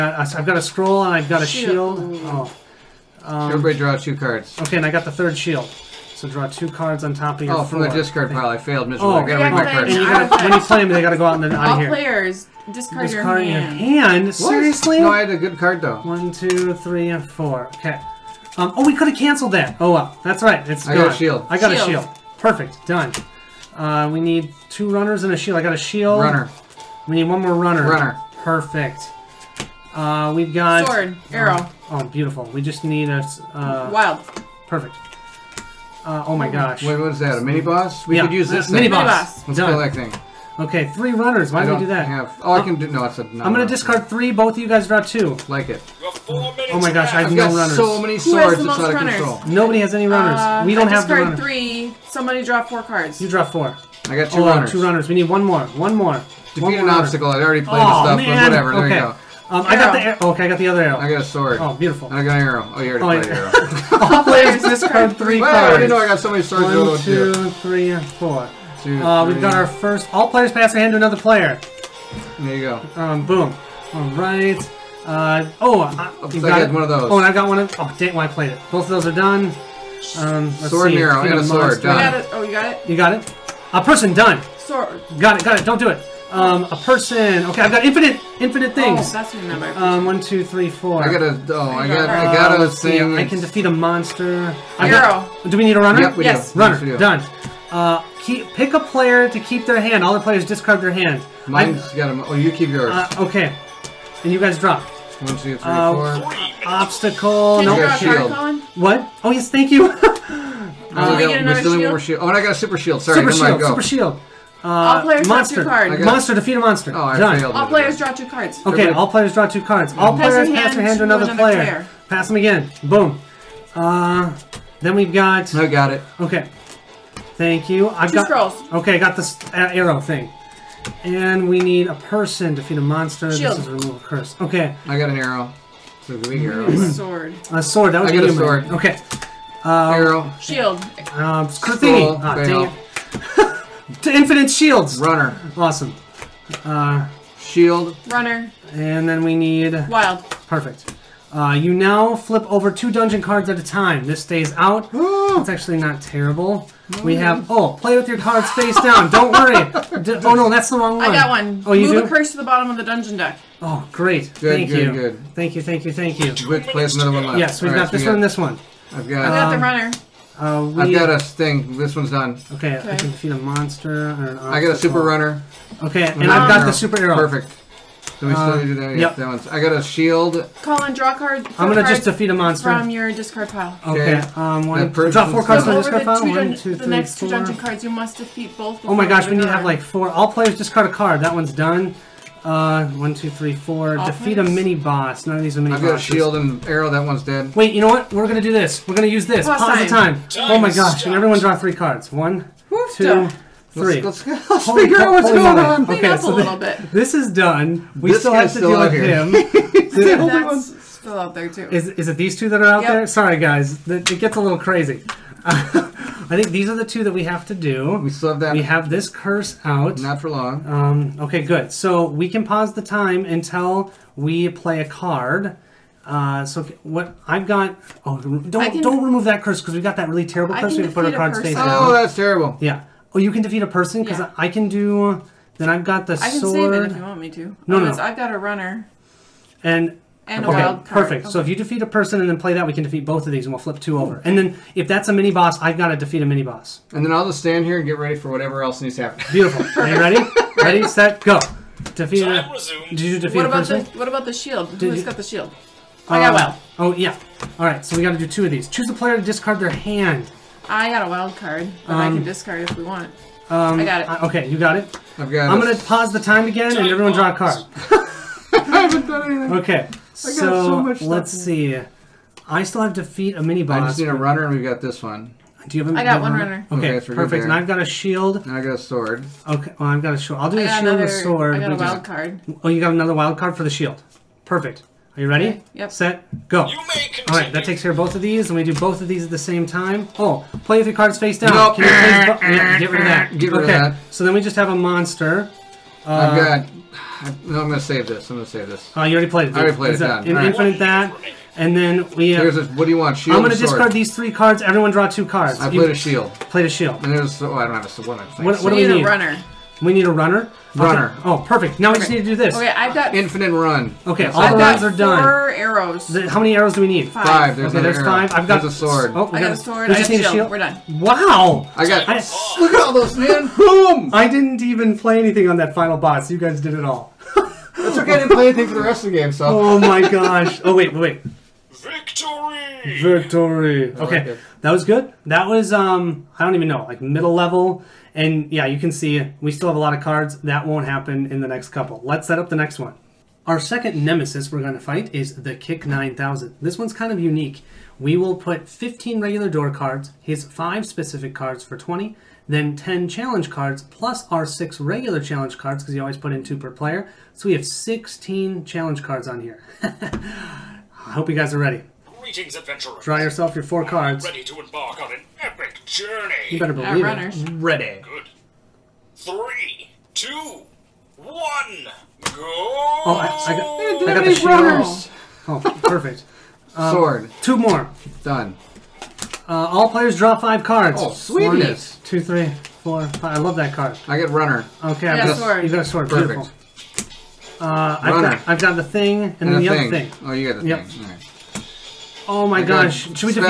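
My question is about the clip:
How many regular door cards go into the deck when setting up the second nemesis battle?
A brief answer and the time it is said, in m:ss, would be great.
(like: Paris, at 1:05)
15, at 5:48.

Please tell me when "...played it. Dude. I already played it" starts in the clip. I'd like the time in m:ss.
4:59.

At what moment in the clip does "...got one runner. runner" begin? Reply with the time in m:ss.
4:36.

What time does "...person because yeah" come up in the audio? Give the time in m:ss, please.
3:53.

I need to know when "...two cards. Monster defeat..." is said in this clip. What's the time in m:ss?
1:55.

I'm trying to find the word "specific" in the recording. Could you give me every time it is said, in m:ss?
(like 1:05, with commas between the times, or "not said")
5:50.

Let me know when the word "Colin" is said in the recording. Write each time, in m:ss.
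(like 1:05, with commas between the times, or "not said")
3:00.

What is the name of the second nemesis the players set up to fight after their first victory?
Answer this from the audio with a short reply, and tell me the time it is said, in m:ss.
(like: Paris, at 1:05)
K.I.C.K. 9000, at 5:45.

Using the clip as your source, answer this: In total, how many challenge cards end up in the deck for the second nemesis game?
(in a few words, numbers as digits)
16.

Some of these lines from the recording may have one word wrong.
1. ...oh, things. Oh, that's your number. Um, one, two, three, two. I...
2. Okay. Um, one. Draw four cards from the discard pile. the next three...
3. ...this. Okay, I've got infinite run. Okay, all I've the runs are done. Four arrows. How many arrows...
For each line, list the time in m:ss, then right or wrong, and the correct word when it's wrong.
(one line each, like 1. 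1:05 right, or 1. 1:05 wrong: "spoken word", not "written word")
1. 1:28 wrong: "four", not "two"
2. 3:04 wrong: "two", not "three"
3. 5:12 right.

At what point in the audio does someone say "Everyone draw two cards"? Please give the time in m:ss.
5:04.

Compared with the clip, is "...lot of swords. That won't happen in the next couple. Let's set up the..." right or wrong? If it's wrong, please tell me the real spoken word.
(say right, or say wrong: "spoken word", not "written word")
wrong: "cards", not "swords".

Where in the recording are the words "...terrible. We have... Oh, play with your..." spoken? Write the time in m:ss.
2:36.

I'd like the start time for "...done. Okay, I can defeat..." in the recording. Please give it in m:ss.
2:52.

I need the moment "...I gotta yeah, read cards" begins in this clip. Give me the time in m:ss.
0:09.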